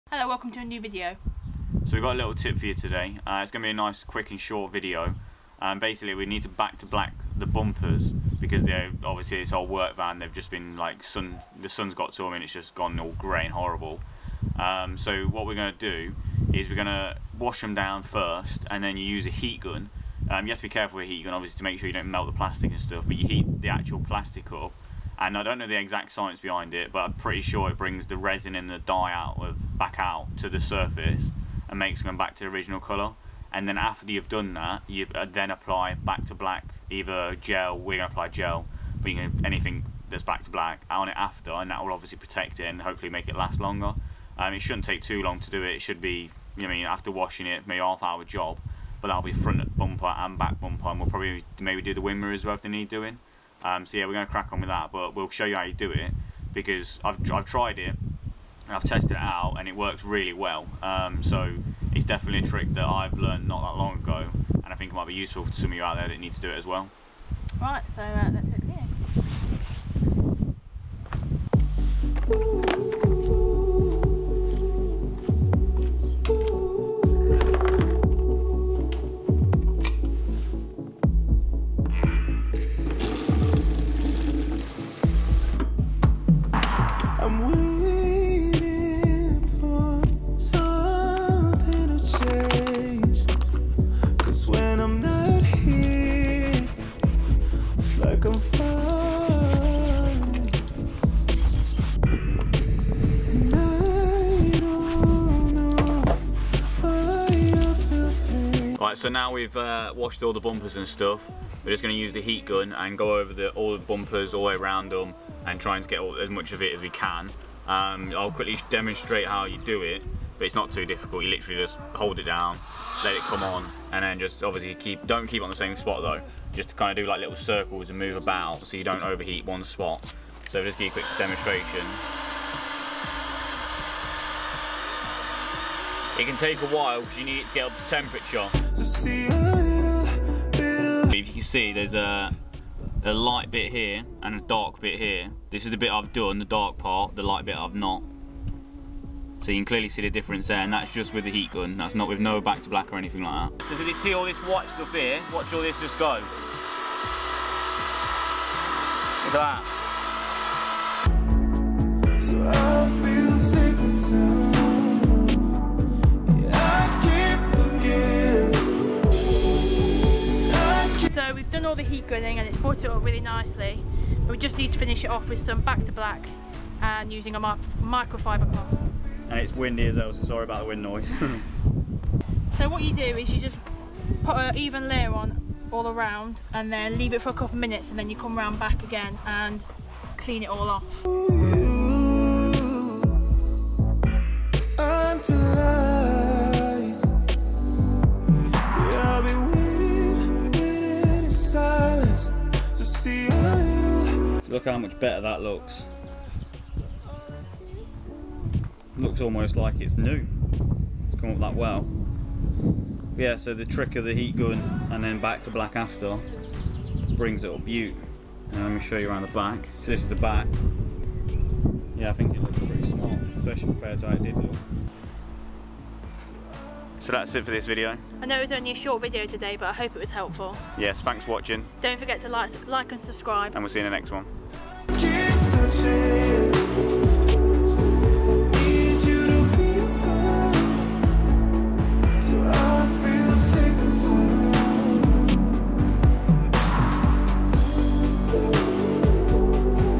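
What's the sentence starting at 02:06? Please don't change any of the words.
Just to kind of do like little circles and move about so you don't overheat one spot.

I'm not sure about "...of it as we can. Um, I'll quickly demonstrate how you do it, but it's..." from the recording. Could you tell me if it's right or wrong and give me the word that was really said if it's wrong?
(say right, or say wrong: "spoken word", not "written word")
right.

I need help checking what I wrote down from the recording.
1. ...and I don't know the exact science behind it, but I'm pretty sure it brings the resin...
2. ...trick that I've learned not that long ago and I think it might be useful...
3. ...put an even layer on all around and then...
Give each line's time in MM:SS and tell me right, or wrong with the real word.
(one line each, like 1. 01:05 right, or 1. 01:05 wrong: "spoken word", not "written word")
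1. 00:25 right
2. 01:02 right
3. 03:04 right.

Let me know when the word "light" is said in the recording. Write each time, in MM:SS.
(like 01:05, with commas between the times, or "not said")
02:23, 02:27.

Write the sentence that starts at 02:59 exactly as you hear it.
And it's windy as well, so sorry about the wind noise.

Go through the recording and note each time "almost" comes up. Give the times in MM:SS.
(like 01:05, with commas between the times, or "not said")
03:29.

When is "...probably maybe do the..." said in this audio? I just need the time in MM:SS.
00:51.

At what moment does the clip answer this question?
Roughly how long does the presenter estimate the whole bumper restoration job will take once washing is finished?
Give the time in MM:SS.
00:47.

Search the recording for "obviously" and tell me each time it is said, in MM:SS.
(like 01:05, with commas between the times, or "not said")
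00:09, 00:21, 00:41, 02:04.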